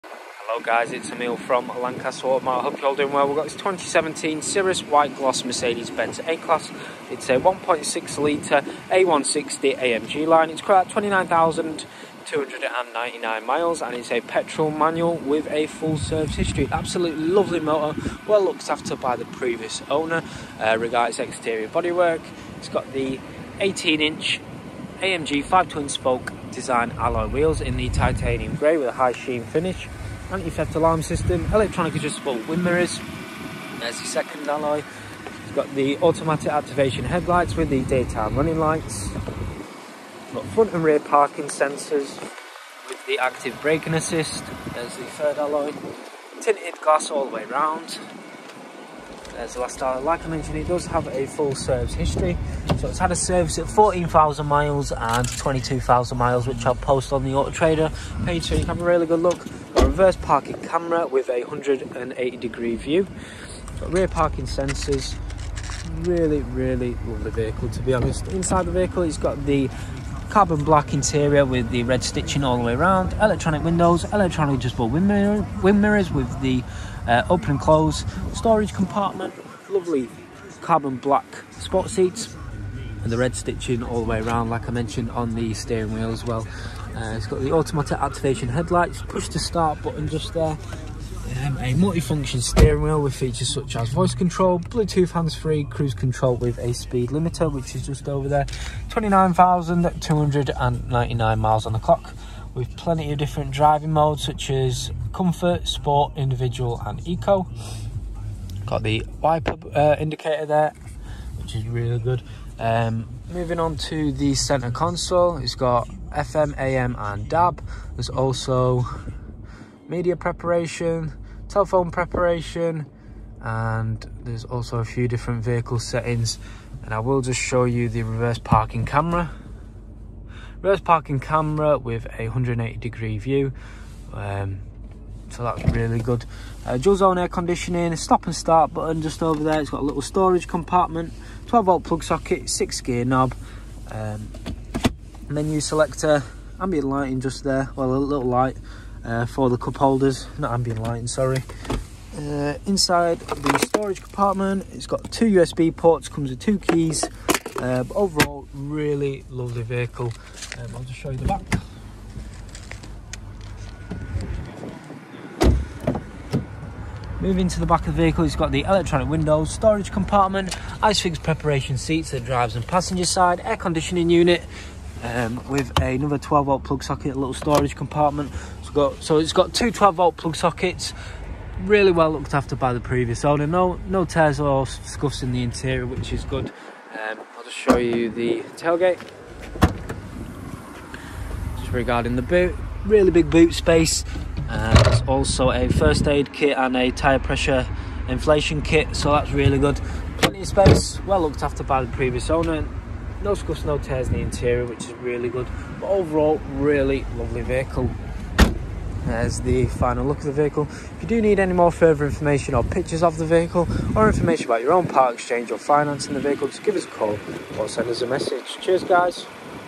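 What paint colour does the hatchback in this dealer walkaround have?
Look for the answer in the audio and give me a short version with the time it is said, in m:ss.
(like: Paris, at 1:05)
Cirrus White Gloss, at 0:04.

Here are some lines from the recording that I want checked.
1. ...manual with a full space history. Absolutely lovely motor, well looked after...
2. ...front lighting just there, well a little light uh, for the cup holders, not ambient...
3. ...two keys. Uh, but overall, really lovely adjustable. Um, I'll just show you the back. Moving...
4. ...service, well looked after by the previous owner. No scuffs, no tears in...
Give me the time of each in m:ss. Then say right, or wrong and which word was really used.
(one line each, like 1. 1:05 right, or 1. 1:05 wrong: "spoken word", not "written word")
1. 0:14 wrong: "service", not "space"
2. 2:26 wrong: "ambient", not "front"
3. 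2:36 wrong: "vehicle", not "adjustable"
4. 3:20 wrong: "space", not "service".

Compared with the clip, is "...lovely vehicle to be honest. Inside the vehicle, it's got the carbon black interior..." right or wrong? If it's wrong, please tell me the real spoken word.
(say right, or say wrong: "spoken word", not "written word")
right.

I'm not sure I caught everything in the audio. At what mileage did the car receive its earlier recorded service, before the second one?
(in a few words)
14,000 miles.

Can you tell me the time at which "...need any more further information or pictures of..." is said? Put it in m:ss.
3:31.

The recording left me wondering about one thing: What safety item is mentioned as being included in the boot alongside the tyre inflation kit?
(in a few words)
First aid kit.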